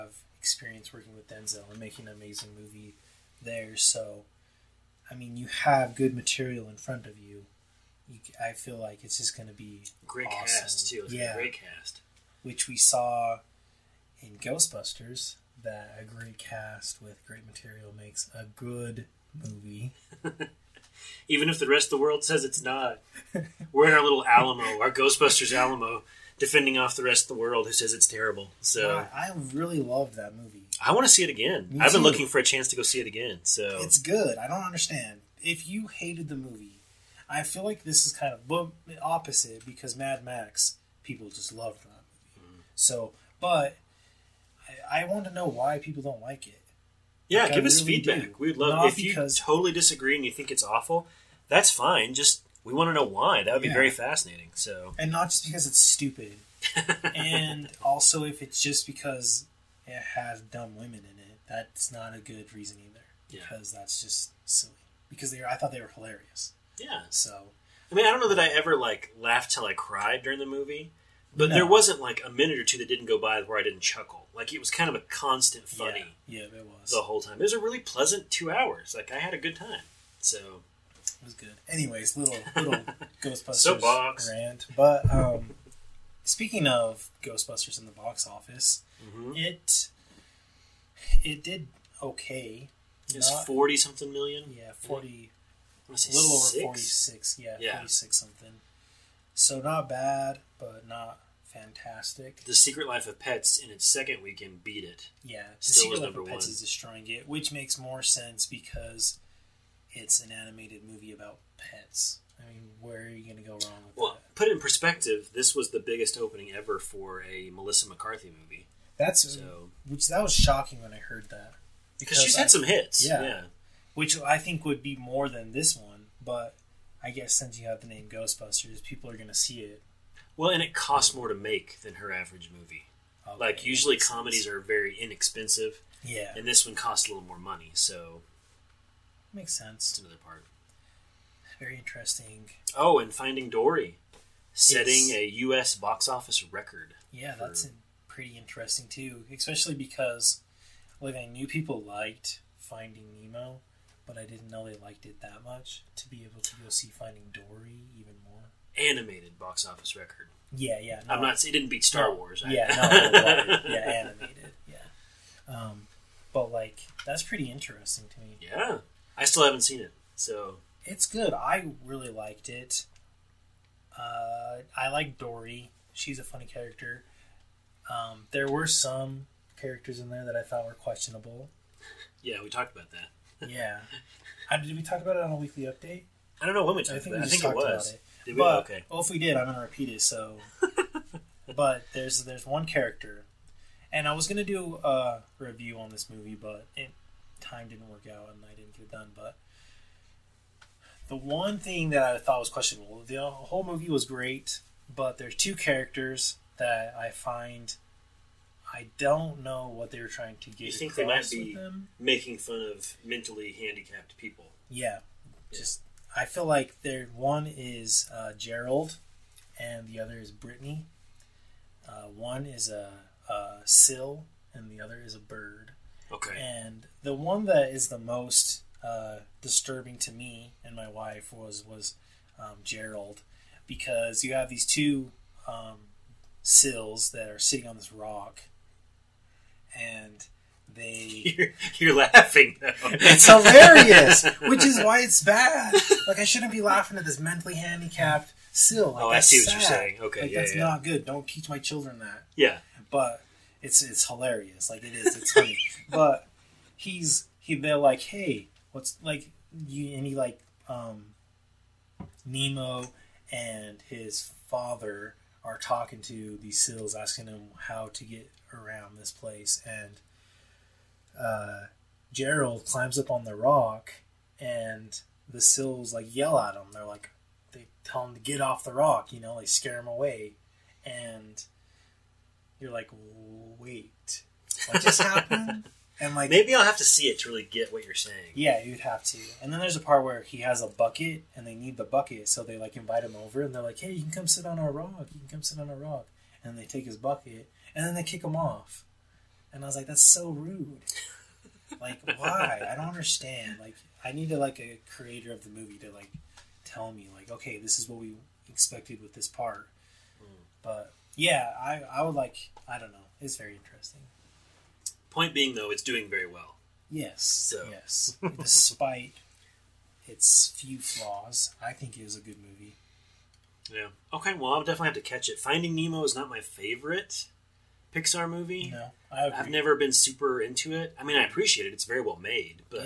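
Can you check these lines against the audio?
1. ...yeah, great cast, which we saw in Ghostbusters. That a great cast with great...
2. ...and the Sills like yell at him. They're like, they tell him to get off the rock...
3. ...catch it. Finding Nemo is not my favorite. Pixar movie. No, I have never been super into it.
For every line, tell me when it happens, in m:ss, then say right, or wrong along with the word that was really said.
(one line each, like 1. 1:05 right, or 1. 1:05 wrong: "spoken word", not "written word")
1. 0:11 right
2. 4:34 right
3. 5:24 right.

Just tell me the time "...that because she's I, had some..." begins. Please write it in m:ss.
2:01.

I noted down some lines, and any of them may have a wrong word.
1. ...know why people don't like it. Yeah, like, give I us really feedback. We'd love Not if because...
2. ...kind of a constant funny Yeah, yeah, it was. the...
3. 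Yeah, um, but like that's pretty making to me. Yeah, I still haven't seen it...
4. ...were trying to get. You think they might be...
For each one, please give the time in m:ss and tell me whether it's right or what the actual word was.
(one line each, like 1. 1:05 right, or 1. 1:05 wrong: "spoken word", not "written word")
1. 0:45 right
2. 1:14 right
3. 2:44 wrong: "interesting", not "making"
4. 3:29 right.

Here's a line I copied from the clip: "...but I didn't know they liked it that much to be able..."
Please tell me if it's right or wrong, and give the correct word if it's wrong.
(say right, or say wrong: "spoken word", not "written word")
right.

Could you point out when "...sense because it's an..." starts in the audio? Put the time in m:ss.
1:48.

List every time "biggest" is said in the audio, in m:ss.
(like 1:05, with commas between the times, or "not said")
1:55.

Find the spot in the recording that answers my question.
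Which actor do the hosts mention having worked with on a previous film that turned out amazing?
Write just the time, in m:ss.
0:01.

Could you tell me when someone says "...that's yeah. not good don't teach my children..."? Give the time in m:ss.
4:10.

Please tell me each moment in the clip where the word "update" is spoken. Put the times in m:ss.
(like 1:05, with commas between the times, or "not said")
3:05.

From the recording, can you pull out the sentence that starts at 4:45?
and like maybe I'll have to see it to really get what you're saying.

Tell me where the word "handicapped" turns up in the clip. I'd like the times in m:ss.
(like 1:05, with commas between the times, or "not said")
3:33, 4:07.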